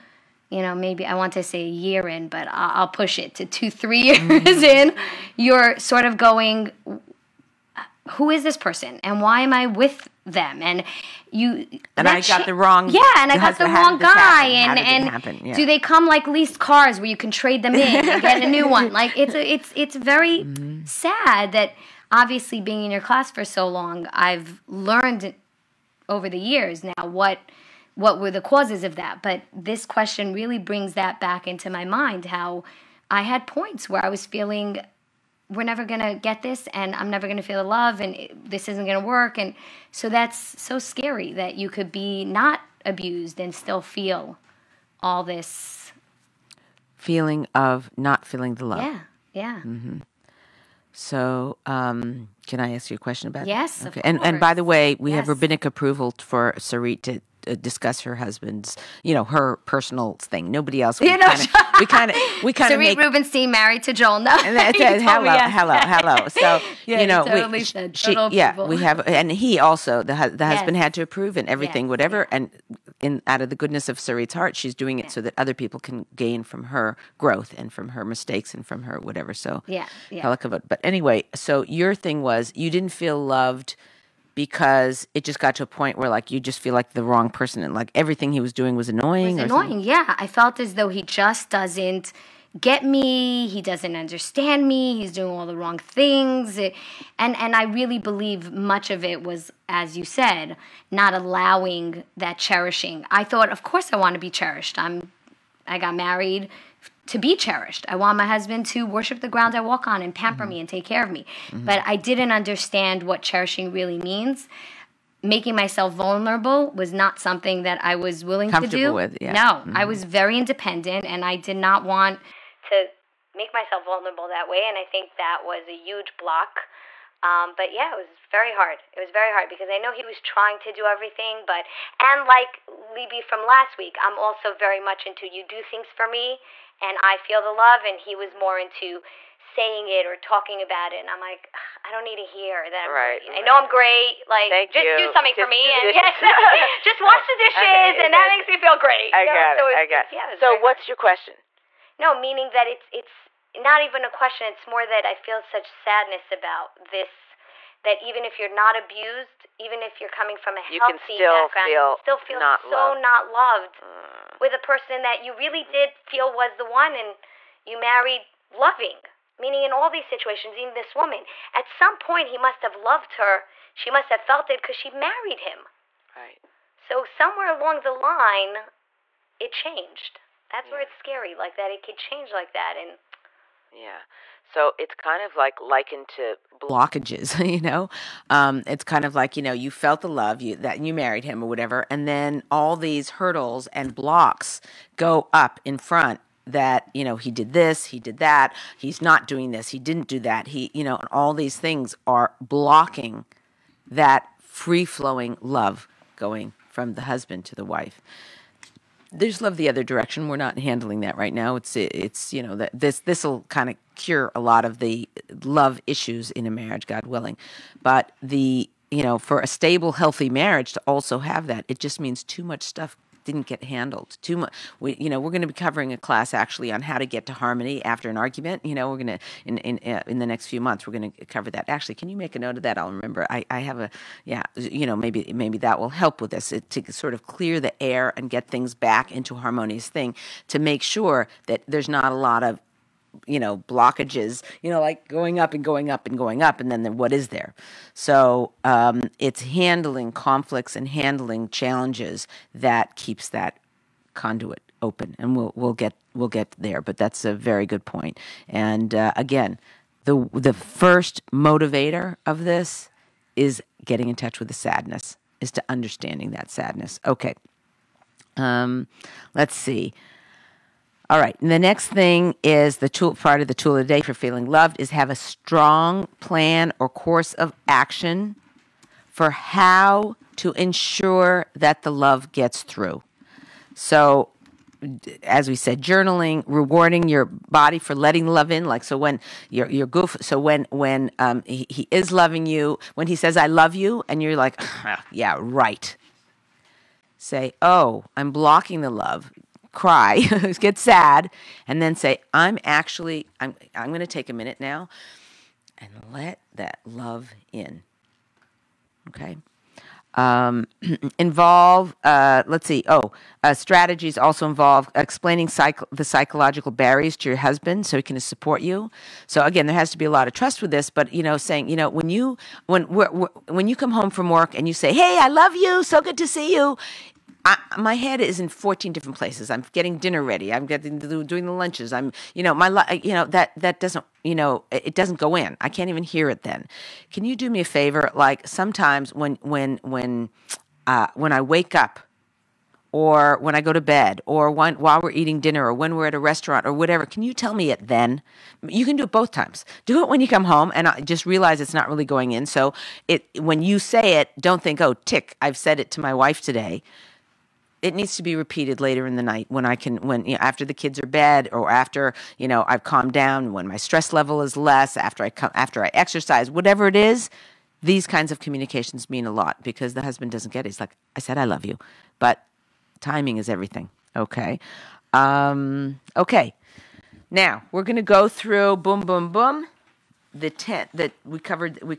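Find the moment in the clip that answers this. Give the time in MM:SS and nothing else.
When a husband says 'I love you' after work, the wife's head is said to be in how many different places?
05:28.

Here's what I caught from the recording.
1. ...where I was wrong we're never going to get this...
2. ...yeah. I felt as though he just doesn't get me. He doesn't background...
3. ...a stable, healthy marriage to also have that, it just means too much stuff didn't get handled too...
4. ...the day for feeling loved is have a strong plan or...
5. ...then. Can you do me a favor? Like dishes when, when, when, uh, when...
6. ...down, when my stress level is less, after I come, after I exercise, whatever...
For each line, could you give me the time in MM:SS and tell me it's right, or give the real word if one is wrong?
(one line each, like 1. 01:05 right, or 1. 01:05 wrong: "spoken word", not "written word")
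1. 00:33 wrong: "feeling", not "wrong"
2. 01:29 wrong: "understand", not "background"
3. 03:39 right
4. 04:33 right
5. 05:36 wrong: "sometimes", not "dishes"
6. 06:03 right.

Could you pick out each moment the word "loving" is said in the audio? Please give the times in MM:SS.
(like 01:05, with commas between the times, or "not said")
02:48, 04:52.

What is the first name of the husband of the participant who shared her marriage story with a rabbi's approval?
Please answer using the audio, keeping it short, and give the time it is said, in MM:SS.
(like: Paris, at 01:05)
Joel, at 01:03.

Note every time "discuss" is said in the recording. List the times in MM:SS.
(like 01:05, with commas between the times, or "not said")
00:57.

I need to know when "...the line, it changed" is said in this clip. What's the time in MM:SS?
02:57.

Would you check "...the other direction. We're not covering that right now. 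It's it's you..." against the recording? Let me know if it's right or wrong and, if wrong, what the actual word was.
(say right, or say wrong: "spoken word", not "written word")
wrong: "handling", not "covering".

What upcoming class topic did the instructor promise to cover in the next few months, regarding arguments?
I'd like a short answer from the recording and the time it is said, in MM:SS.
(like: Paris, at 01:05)
harmony after an argument, at 03:47.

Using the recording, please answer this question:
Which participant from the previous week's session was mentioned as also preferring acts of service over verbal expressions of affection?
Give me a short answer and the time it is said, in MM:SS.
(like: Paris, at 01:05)
Libby, at 02:12.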